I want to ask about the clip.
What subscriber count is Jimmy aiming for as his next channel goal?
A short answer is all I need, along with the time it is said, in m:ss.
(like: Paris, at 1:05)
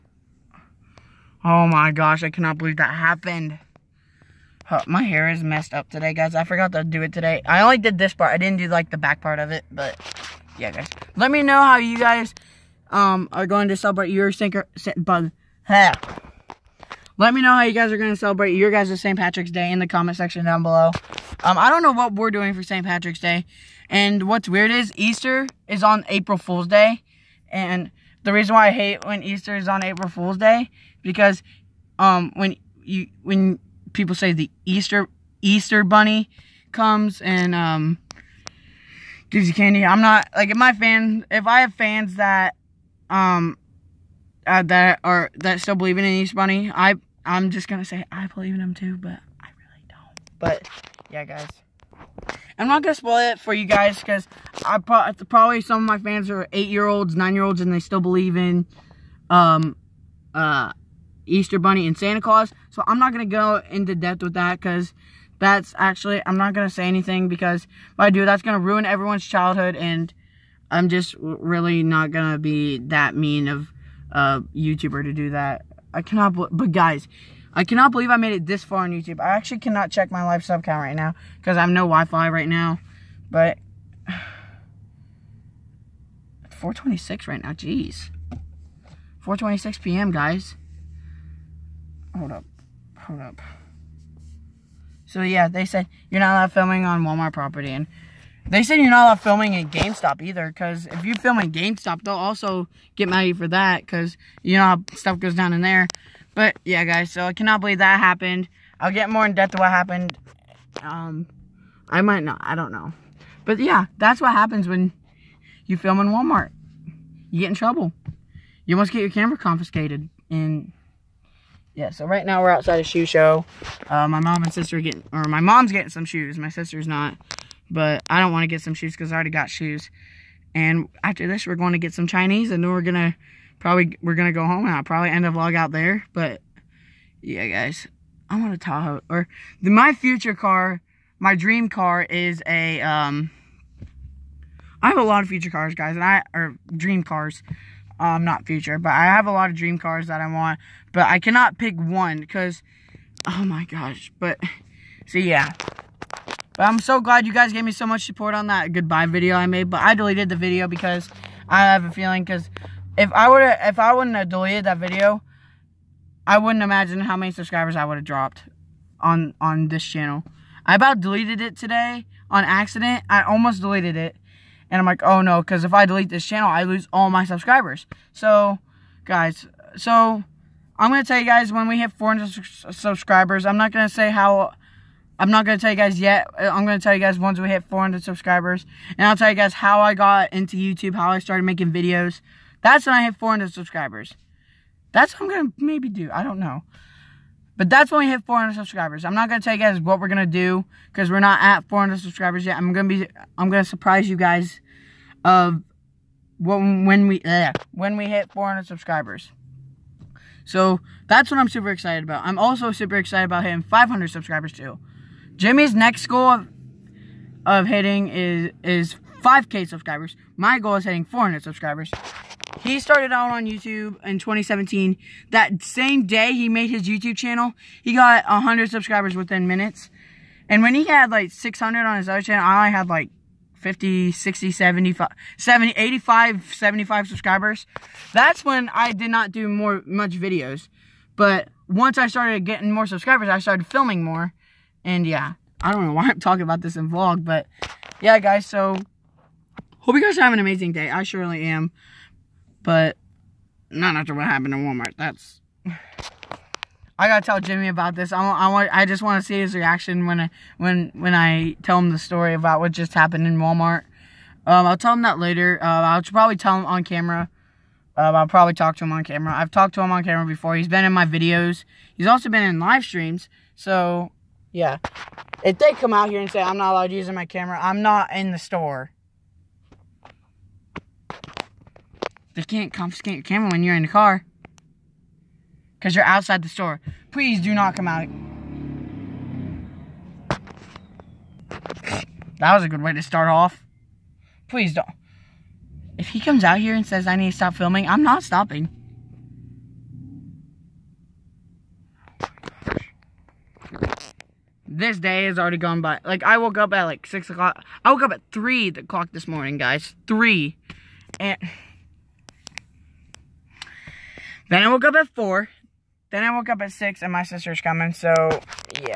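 5k, at 3:39.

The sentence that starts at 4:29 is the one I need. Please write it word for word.
I've talked to him on camera before.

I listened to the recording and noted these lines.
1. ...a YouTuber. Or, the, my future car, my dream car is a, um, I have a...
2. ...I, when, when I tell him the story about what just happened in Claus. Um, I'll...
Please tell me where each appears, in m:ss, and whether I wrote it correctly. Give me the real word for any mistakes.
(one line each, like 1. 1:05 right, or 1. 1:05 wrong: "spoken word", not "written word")
1. 2:18 wrong: "Tahoe", not "YouTuber"
2. 4:20 wrong: "Walmart", not "Claus".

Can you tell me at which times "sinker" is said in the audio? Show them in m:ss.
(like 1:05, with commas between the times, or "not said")
0:14.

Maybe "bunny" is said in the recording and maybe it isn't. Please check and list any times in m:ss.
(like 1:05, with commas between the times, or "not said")
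0:35, 0:46, 1:01.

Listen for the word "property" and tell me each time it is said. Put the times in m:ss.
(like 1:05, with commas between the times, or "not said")
1:37.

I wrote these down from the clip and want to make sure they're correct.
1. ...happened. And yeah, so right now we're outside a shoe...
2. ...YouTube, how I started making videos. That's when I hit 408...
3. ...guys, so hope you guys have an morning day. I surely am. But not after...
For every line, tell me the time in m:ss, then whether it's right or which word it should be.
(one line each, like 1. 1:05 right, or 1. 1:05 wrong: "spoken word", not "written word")
1. 1:59 wrong: "confiscated", not "happened"
2. 3:10 wrong: "400", not "408"
3. 4:08 wrong: "amazing", not "morning".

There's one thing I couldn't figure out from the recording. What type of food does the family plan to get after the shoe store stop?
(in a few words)
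Chinese.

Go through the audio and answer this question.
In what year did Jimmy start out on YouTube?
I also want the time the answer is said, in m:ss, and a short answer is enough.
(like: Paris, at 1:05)
2017, at 3:44.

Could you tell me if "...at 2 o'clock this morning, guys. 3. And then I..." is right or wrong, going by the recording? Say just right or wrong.
wrong.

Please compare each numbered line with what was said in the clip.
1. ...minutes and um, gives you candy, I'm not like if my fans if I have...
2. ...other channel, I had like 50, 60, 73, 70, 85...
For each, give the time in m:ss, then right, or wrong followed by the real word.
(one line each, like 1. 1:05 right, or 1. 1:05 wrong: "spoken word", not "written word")
1. 0:36 wrong: "comes", not "minutes"
2. 3:52 wrong: "75", not "73".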